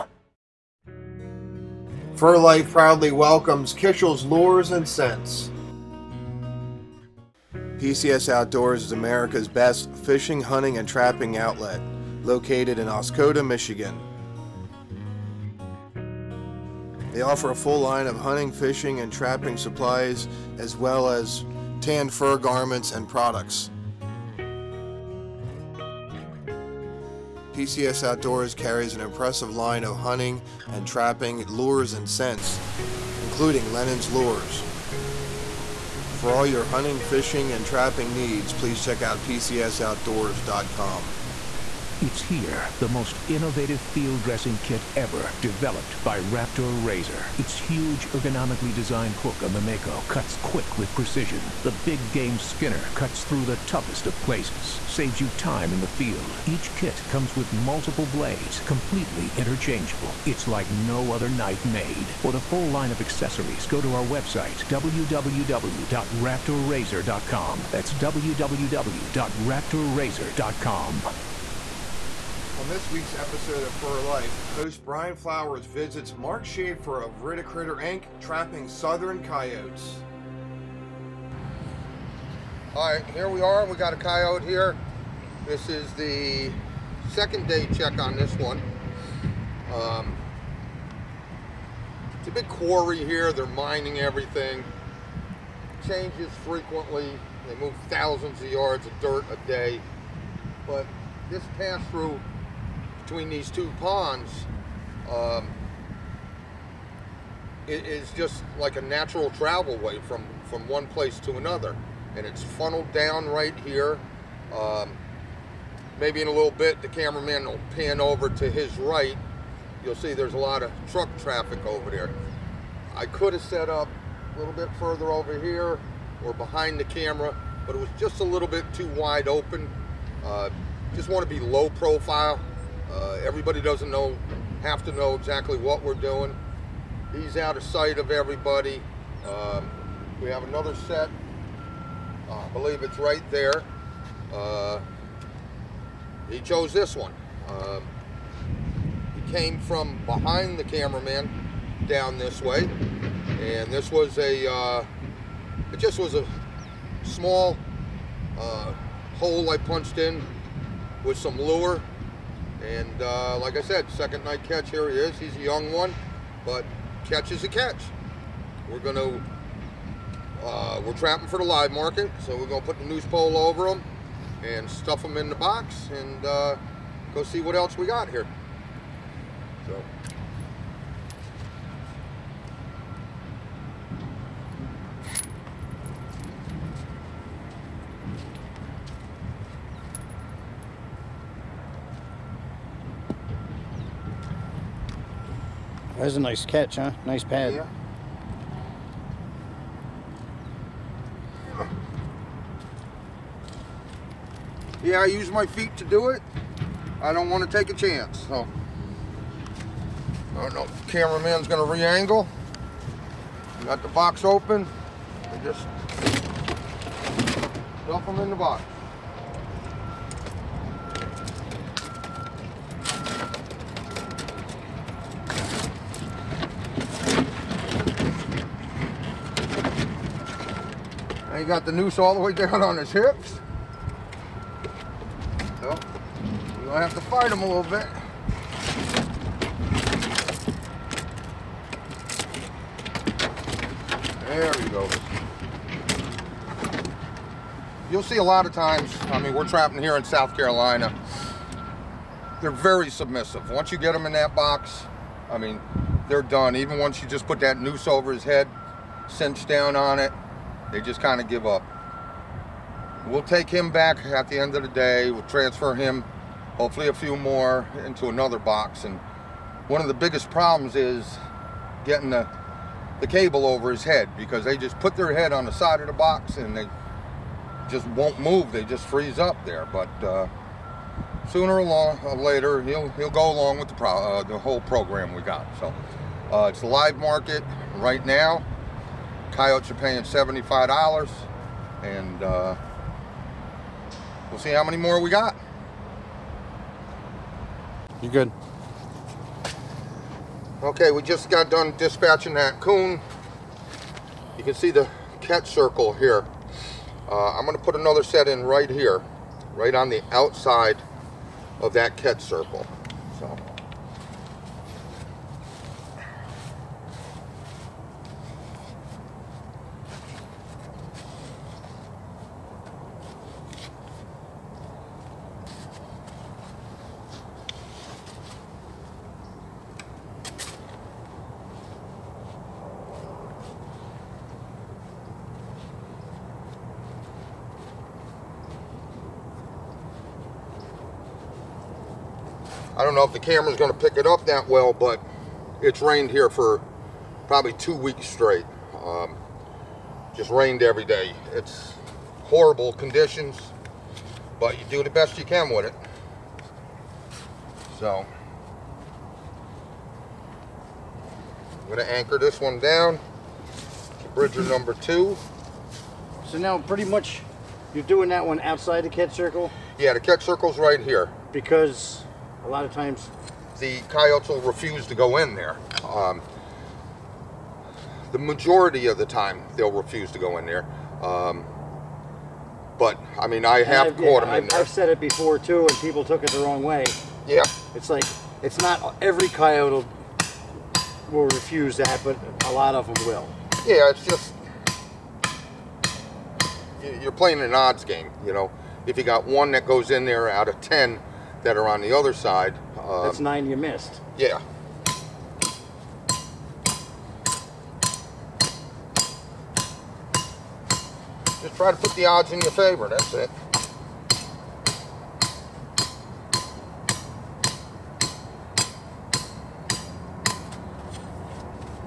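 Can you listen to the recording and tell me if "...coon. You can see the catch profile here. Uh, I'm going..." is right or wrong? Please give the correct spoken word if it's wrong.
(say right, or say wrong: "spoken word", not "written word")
wrong: "circle", not "profile".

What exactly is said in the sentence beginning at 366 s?
So now pretty much you're doing that one outside the catch circle?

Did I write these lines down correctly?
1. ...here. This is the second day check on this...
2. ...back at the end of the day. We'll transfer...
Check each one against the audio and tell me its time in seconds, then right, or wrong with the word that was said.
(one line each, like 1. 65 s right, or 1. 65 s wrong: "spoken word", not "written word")
1. 84 s right
2. 263 s right.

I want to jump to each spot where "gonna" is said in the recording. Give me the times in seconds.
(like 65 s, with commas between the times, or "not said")
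211 s, 236 s.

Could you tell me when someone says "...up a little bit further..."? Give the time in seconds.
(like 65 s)
123 s.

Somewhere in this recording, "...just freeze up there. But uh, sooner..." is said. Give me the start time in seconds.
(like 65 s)
278 s.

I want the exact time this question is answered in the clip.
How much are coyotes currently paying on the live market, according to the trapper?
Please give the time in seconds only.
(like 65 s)
290 s.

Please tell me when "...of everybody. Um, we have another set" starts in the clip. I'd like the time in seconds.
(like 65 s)
137 s.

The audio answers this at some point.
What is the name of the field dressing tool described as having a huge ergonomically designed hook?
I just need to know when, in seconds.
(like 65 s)
49 s.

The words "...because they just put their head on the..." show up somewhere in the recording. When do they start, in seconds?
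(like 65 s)
274 s.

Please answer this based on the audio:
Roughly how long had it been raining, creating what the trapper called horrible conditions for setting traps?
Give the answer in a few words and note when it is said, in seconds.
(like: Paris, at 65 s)
2 weeks, at 347 s.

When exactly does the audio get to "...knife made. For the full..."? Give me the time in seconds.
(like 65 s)
61 s.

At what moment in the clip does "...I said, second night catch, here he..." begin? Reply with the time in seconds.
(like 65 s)
163 s.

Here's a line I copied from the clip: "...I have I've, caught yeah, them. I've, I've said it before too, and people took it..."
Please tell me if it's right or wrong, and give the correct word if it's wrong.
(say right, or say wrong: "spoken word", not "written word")
right.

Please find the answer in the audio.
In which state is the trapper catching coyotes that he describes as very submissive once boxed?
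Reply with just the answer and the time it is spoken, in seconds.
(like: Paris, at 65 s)
South Carolina, at 250 s.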